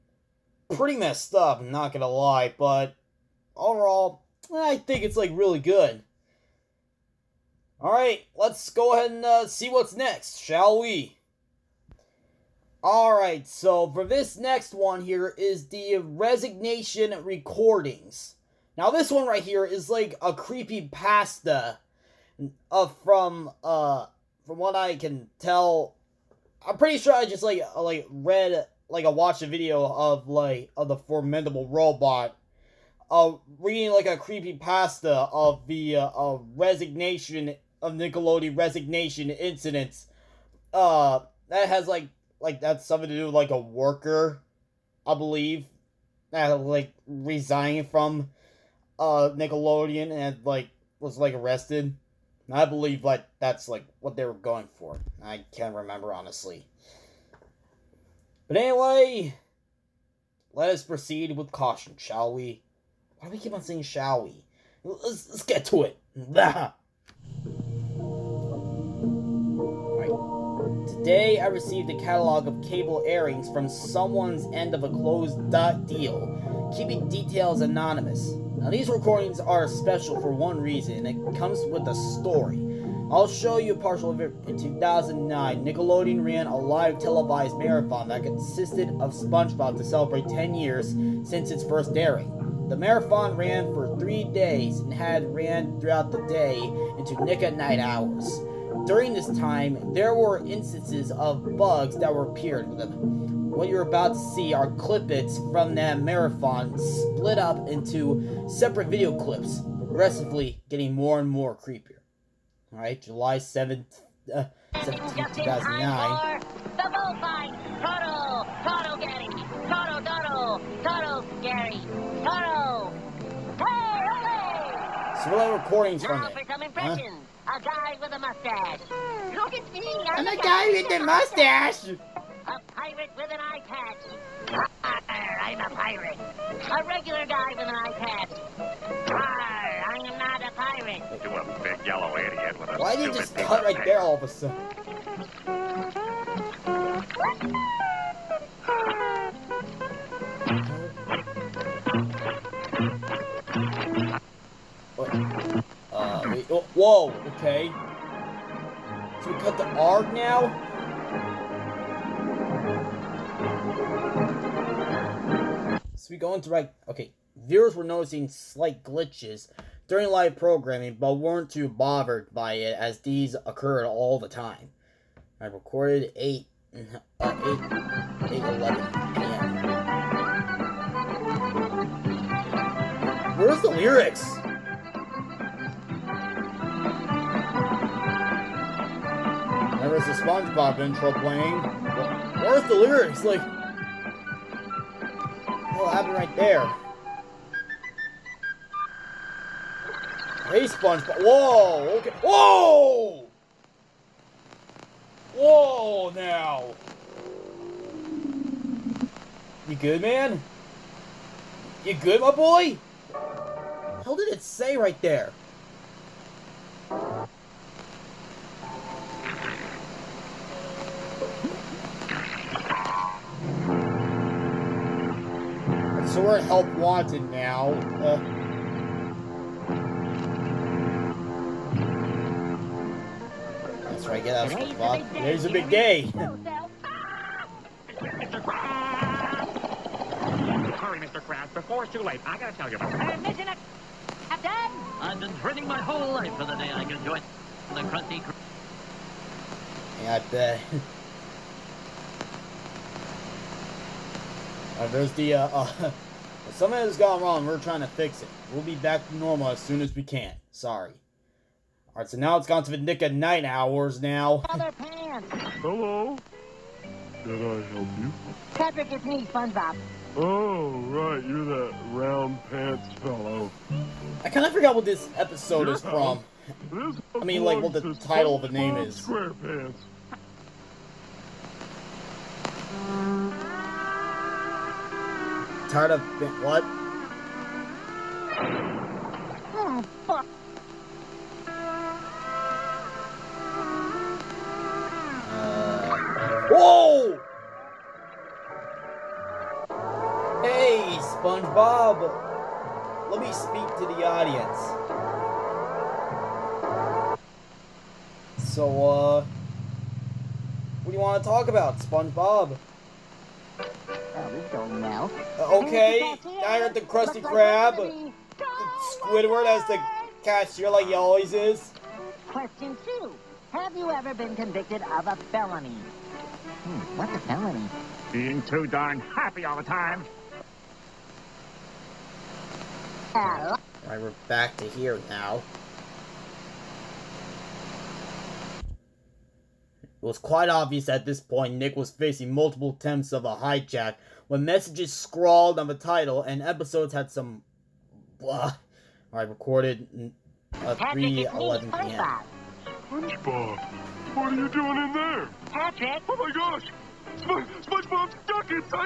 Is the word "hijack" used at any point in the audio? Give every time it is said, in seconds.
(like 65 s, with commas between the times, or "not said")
343 s.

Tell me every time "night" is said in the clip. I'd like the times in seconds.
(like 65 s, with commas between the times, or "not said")
263 s.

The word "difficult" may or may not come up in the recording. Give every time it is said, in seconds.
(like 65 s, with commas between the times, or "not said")
not said.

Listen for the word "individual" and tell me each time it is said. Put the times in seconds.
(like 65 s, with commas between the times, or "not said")
not said.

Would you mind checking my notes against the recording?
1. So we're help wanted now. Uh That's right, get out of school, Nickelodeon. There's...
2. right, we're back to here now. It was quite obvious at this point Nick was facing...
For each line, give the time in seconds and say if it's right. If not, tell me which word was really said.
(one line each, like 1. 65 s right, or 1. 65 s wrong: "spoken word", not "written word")
1. 226 s wrong: "Bob", not "Nickelodeon"
2. 333 s right.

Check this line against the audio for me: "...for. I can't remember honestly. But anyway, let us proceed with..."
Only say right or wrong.
right.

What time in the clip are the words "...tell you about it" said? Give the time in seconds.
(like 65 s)
242 s.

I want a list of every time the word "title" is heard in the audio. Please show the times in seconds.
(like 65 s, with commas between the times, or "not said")
277 s, 345 s.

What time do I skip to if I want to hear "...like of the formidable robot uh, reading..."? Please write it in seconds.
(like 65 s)
30 s.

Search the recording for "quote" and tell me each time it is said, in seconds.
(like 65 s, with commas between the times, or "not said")
not said.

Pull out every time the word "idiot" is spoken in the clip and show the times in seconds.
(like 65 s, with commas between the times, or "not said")
142 s.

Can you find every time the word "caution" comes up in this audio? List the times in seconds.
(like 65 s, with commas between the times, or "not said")
61 s.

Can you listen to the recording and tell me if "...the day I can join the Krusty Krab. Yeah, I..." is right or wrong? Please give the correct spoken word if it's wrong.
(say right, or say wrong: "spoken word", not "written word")
right.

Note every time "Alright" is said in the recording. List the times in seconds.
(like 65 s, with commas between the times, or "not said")
7 s, 12 s, 112 s, 261 s.